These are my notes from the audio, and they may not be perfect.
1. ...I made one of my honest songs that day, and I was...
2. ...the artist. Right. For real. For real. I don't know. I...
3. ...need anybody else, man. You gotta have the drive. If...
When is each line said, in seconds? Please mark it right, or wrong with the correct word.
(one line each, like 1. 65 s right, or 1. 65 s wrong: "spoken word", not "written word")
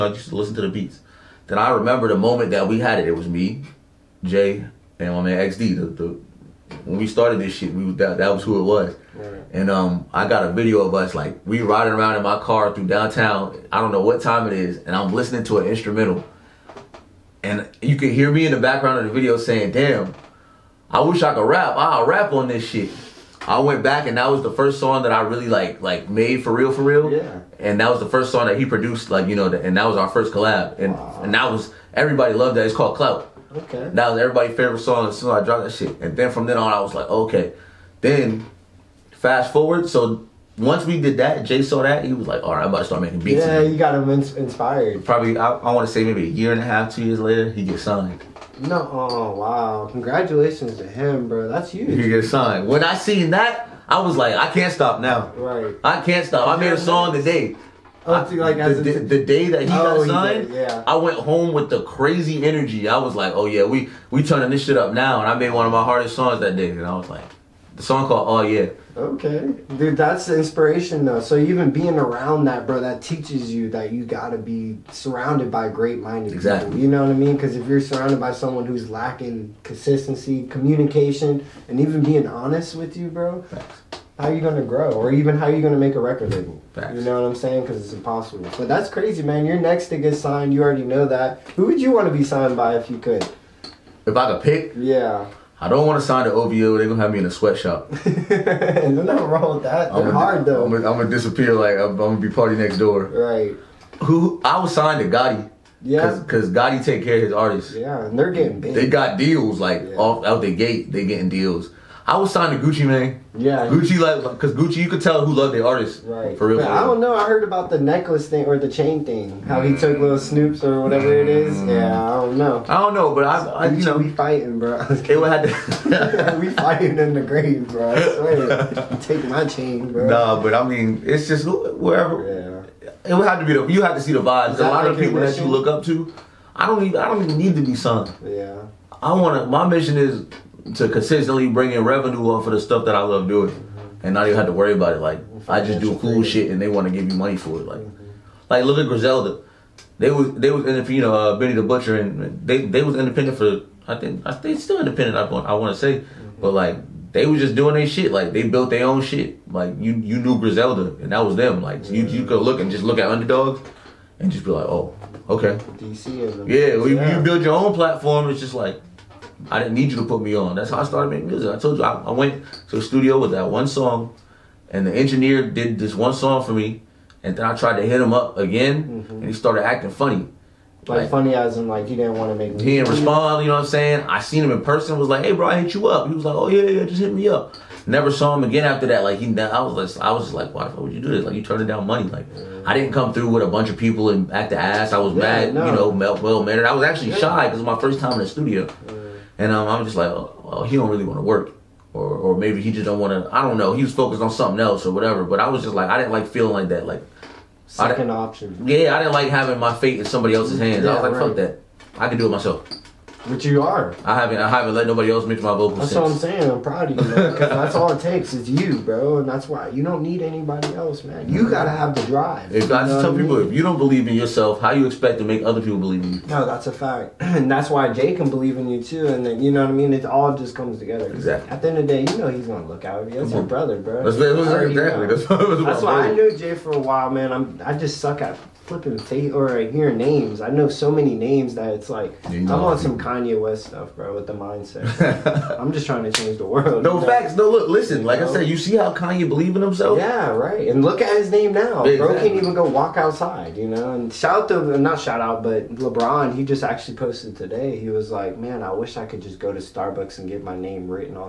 1. 65 s wrong: "hardest", not "honest"
2. 115 s right
3. 220 s right.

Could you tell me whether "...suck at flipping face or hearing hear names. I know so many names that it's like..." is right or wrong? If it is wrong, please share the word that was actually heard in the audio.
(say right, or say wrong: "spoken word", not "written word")
right.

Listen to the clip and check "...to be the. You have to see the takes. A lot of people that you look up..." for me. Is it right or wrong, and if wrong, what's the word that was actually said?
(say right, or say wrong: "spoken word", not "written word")
wrong: "vibes", not "takes".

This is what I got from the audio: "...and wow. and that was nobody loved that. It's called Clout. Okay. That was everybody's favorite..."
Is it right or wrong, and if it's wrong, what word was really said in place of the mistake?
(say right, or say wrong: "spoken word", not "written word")
wrong: "everybody", not "nobody".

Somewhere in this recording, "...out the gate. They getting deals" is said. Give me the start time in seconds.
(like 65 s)
110 s.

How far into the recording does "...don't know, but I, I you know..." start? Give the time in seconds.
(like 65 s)
122 s.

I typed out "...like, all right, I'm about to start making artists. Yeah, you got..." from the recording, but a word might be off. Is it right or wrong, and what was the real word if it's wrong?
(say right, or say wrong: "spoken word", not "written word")
wrong: "beats", not "artists".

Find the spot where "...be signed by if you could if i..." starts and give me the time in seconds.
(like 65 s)
92 s.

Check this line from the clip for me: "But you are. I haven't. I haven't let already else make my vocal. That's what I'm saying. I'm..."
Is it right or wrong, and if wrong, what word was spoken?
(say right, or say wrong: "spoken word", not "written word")
wrong: "nobody", not "already".